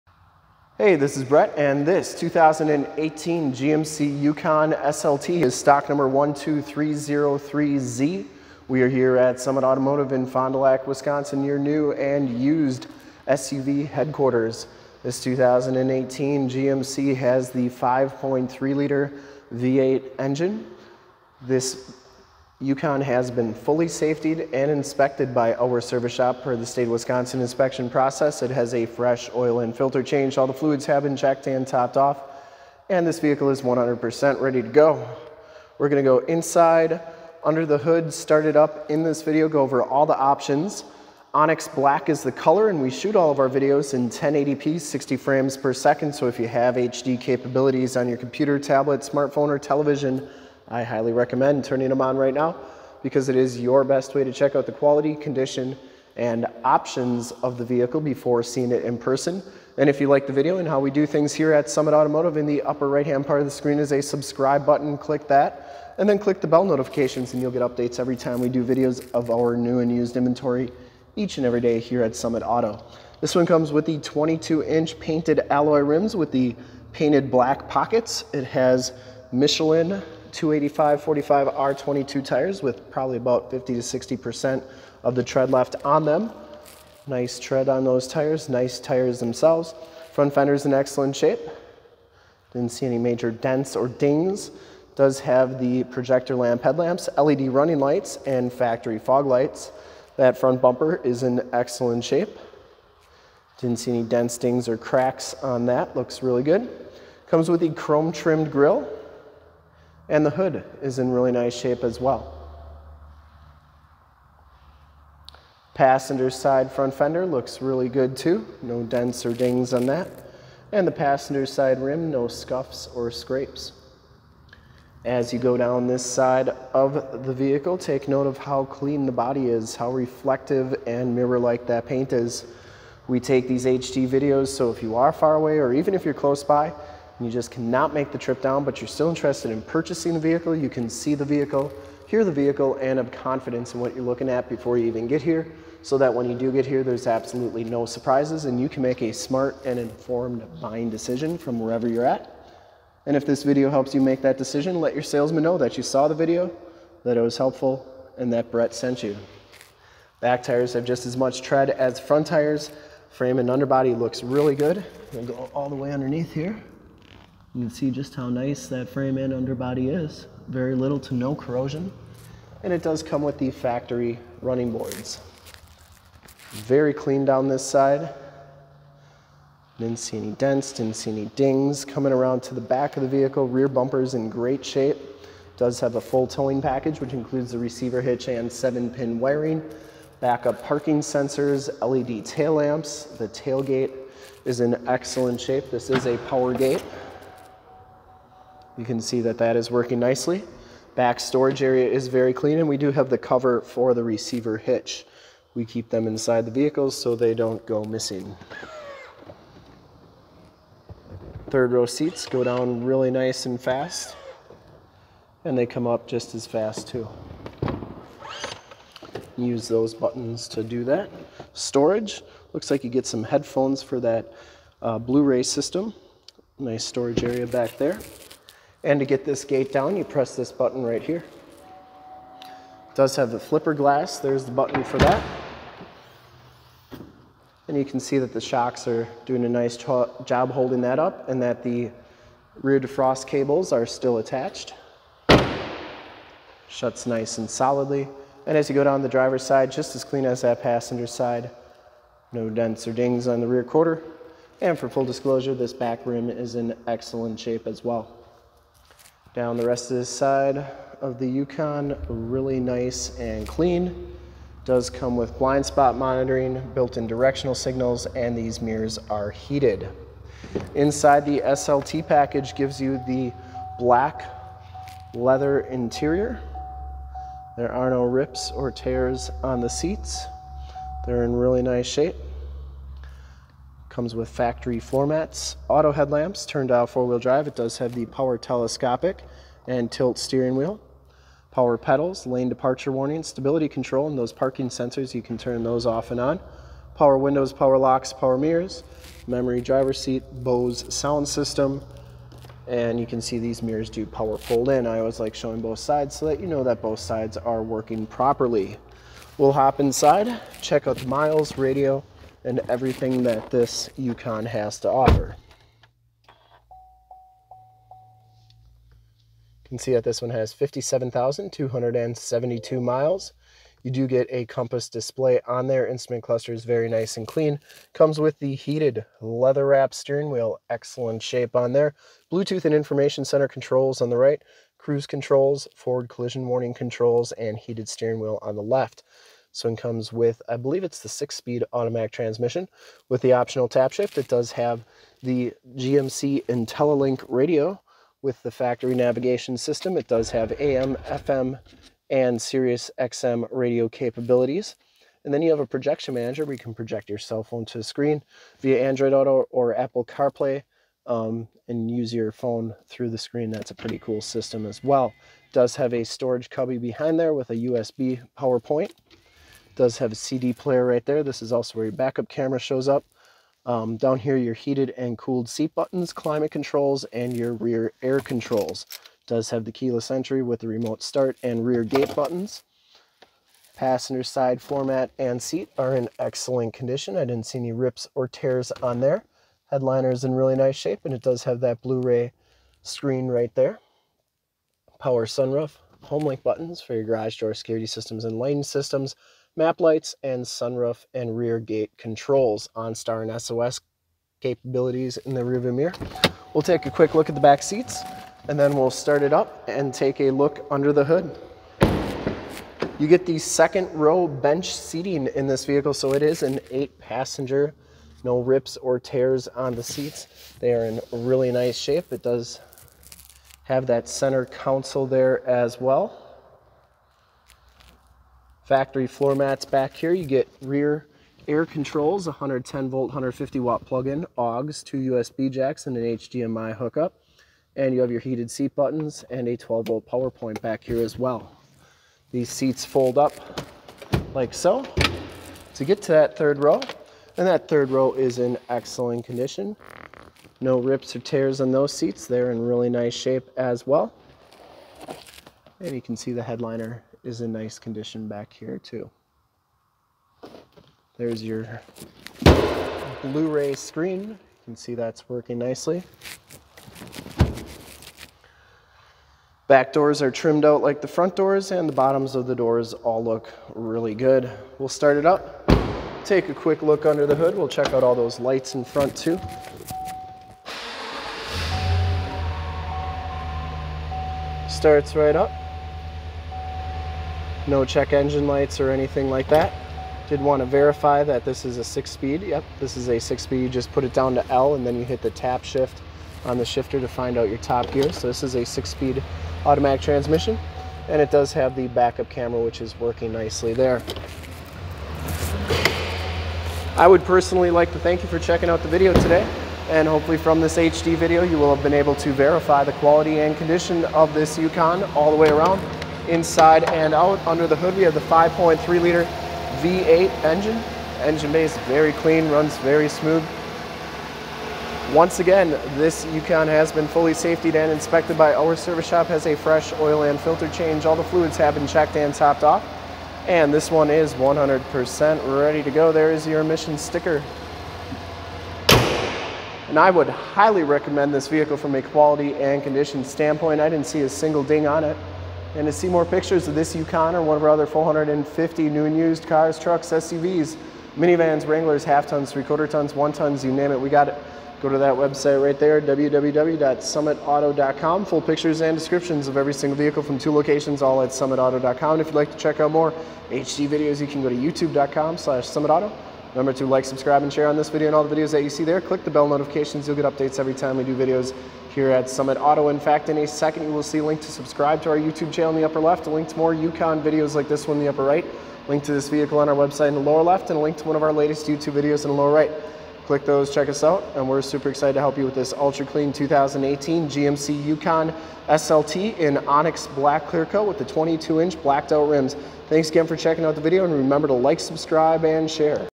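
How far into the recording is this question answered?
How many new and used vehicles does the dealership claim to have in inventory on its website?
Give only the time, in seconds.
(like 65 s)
547 s.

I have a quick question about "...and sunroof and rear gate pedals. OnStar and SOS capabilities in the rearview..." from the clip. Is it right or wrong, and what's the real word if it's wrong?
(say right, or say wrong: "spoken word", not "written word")
wrong: "controls", not "pedals".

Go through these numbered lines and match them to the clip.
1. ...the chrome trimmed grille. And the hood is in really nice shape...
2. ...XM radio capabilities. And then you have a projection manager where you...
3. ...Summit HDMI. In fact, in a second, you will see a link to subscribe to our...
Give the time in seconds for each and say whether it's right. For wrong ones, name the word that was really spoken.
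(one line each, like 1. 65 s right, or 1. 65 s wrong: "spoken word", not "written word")
1. 107 s right
2. 352 s right
3. 572 s wrong: "Auto", not "HDMI".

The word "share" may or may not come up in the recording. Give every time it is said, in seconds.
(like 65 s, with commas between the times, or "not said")
567 s, 595 s.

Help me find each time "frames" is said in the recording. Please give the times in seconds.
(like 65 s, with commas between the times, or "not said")
45 s, 163 s, 168 s.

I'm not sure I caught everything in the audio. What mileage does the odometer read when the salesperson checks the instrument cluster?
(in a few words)
57,272 miles.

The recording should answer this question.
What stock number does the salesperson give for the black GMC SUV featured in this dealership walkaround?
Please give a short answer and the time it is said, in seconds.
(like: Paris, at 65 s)
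12303Z, at 6 s.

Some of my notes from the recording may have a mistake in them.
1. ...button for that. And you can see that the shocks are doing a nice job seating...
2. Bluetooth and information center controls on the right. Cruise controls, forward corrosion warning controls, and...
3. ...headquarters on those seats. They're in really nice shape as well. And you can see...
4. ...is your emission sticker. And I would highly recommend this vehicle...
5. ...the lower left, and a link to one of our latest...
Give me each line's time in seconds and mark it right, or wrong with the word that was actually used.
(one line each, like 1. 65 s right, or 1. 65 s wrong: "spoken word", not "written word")
1. 234 s wrong: "holding", not "seating"
2. 332 s wrong: "collision", not "corrosion"
3. 451 s wrong: "tears", not "headquarters"
4. 536 s right
5. 580 s right.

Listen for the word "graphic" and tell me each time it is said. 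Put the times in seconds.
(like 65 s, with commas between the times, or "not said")
not said.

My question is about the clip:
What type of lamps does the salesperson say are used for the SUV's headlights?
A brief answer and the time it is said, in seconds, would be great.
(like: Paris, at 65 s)
Projector lamp headlamps, at 95 s.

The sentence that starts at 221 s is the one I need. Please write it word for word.
Storage, looks like you get some headphones for that uh, Blu-ray system.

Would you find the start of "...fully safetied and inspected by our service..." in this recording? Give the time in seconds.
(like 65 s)
23 s.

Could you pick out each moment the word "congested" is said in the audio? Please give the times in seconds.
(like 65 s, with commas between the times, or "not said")
not said.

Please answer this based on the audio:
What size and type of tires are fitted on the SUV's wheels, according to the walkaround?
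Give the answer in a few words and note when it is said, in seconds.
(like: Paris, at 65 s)
Michelin 285 45 R22, at 79 s.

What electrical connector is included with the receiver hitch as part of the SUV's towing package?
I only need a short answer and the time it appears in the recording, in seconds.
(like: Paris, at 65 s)
Seven pin wiring, at 188 s.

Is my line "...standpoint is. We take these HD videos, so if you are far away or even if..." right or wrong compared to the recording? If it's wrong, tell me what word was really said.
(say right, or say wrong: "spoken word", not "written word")
wrong: "paint", not "standpoint".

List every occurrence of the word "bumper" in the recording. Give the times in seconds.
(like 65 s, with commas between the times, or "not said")
100 s, 183 s.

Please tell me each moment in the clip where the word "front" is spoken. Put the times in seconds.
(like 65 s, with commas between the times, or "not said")
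90 s, 100 s, 116 s, 161 s, 471 s, 478 s.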